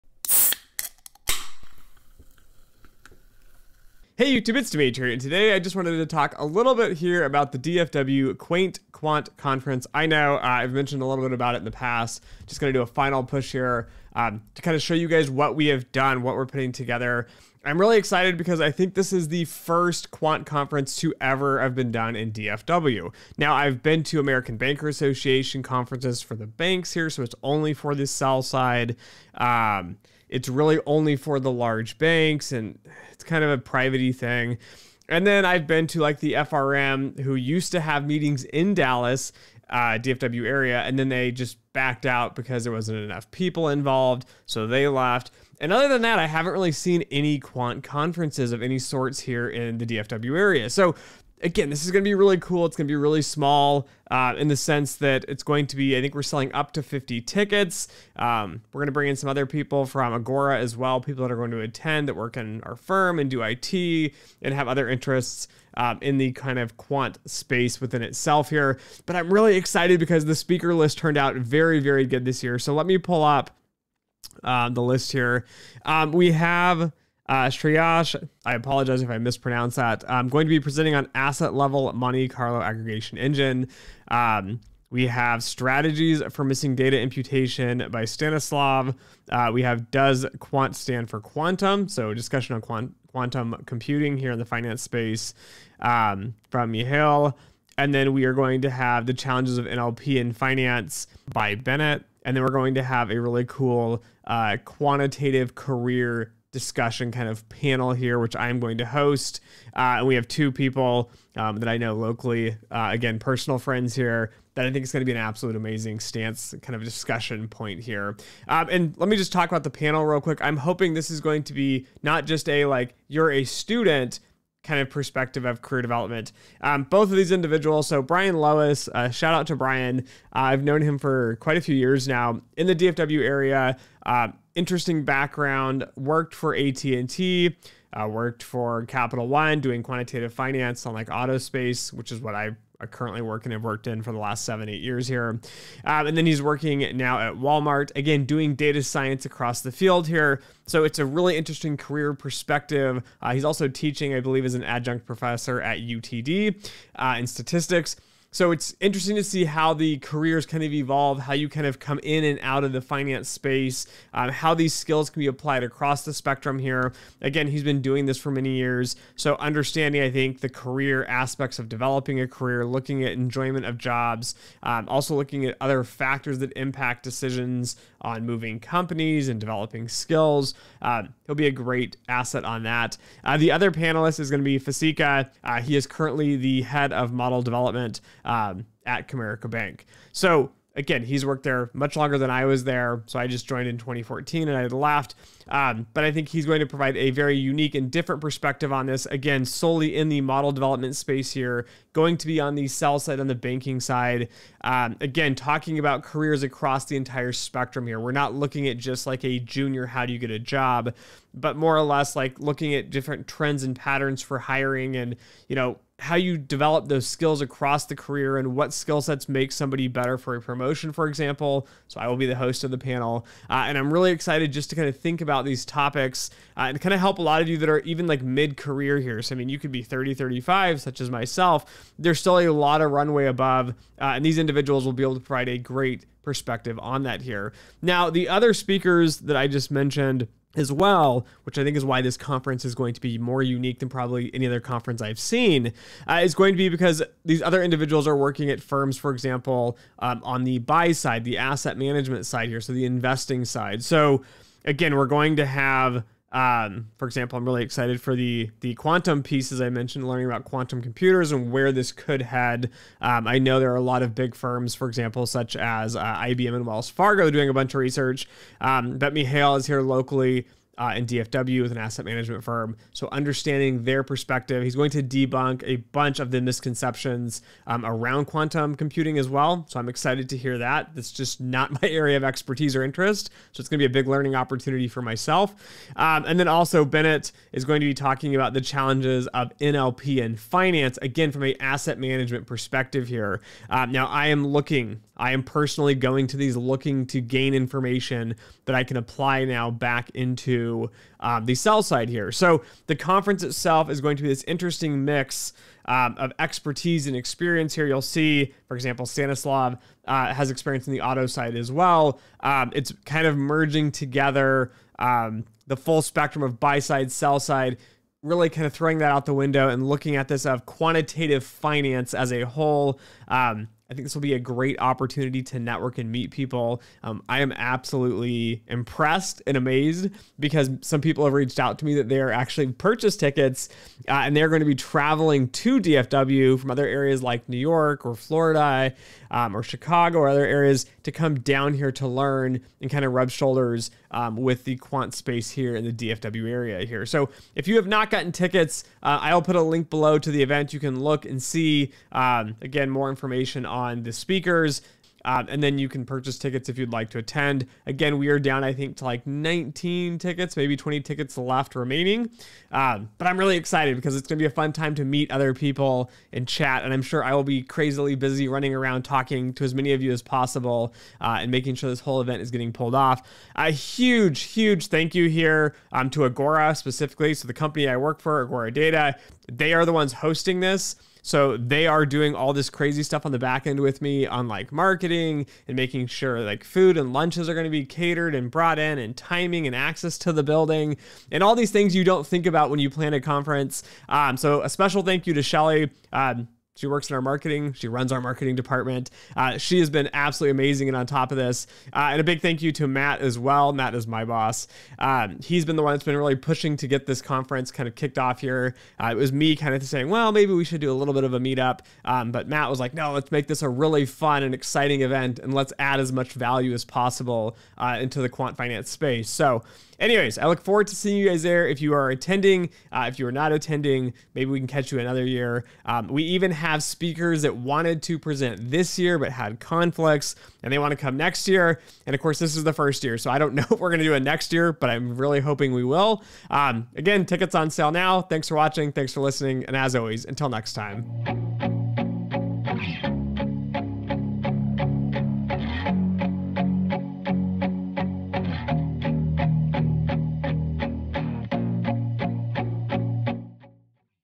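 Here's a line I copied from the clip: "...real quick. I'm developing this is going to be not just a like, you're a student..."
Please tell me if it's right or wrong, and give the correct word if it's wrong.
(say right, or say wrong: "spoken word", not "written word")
wrong: "hoping", not "developing".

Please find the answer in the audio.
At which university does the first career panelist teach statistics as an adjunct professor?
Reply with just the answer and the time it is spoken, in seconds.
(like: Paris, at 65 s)
UTD, at 155 s.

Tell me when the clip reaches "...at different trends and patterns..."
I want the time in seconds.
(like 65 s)
212 s.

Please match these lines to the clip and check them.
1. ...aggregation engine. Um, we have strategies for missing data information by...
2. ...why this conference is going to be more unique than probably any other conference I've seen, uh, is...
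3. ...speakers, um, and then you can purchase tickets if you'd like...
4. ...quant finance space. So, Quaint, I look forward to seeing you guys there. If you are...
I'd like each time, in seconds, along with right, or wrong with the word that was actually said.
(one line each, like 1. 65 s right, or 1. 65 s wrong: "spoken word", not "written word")
1. 82 s wrong: "imputation", not "information"
2. 241 s right
3. 354 s right
4. 418 s wrong: "Anyways", not "Quaint".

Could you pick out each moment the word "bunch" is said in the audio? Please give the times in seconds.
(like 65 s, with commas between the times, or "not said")
267 s, 275 s.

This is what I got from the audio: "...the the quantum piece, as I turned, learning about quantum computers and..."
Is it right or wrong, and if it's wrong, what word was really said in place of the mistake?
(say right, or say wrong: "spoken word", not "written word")
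wrong: "mentioned", not "turned".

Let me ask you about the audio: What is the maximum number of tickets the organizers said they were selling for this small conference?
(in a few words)
50.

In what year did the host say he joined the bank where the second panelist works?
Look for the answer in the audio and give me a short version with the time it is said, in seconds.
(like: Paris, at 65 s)
2014, at 193 s.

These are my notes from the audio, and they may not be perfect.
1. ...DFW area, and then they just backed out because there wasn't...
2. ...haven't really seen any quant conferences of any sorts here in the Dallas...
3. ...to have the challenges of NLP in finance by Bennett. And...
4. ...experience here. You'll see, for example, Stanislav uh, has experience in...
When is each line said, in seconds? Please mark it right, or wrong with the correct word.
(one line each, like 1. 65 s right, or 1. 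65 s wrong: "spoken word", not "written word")
1. 39 s right
2. 46 s wrong: "DFW", not "Dallas"
3. 98 s right
4. 307 s right.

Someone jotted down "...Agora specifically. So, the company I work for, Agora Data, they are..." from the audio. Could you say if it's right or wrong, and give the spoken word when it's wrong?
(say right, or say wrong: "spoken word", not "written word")
right.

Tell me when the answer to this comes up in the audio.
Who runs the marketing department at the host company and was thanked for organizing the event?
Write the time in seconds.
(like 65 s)
395 s.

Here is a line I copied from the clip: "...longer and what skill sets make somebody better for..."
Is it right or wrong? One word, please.
wrong.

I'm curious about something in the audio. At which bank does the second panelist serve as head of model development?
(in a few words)
Comerica Bank.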